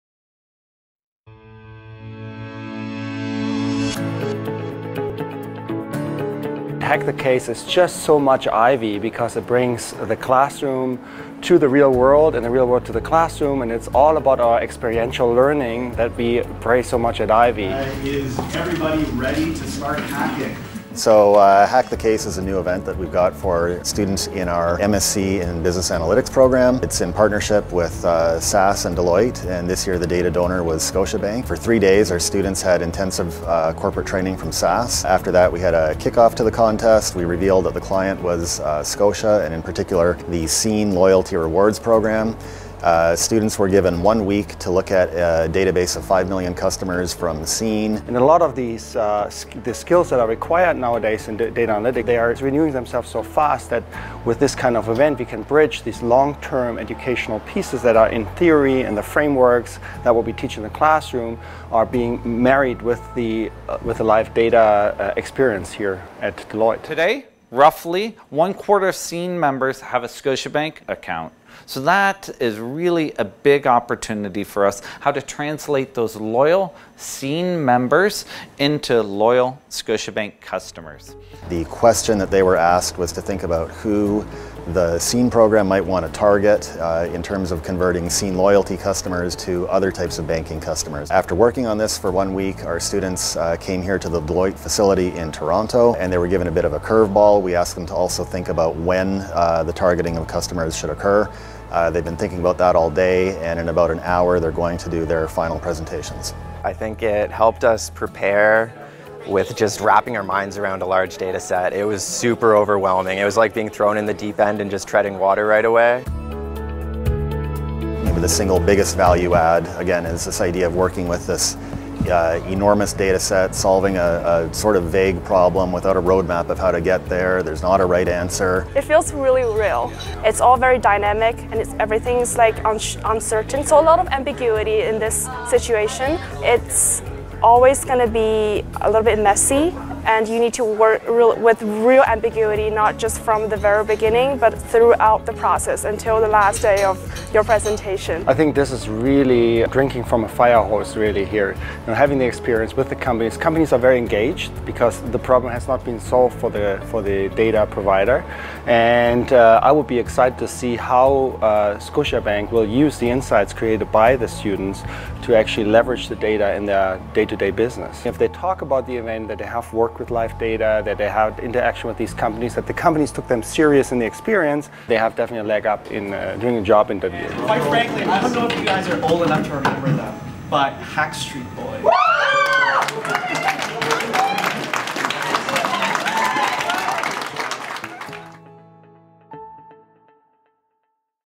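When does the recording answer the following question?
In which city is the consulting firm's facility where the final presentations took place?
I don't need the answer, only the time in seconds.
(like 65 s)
95 s.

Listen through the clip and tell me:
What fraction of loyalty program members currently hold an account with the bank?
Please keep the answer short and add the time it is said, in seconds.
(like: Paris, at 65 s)
one quarter, at 68 s.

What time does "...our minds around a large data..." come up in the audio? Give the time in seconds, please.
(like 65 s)
110 s.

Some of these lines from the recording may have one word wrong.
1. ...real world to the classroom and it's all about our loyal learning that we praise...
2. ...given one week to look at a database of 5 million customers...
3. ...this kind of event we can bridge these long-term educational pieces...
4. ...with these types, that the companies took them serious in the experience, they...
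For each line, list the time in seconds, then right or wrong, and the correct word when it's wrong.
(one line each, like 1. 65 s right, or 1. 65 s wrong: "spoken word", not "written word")
1. 12 s wrong: "experiential", not "loyal"
2. 43 s right
3. 54 s right
4. 171 s wrong: "companies", not "types".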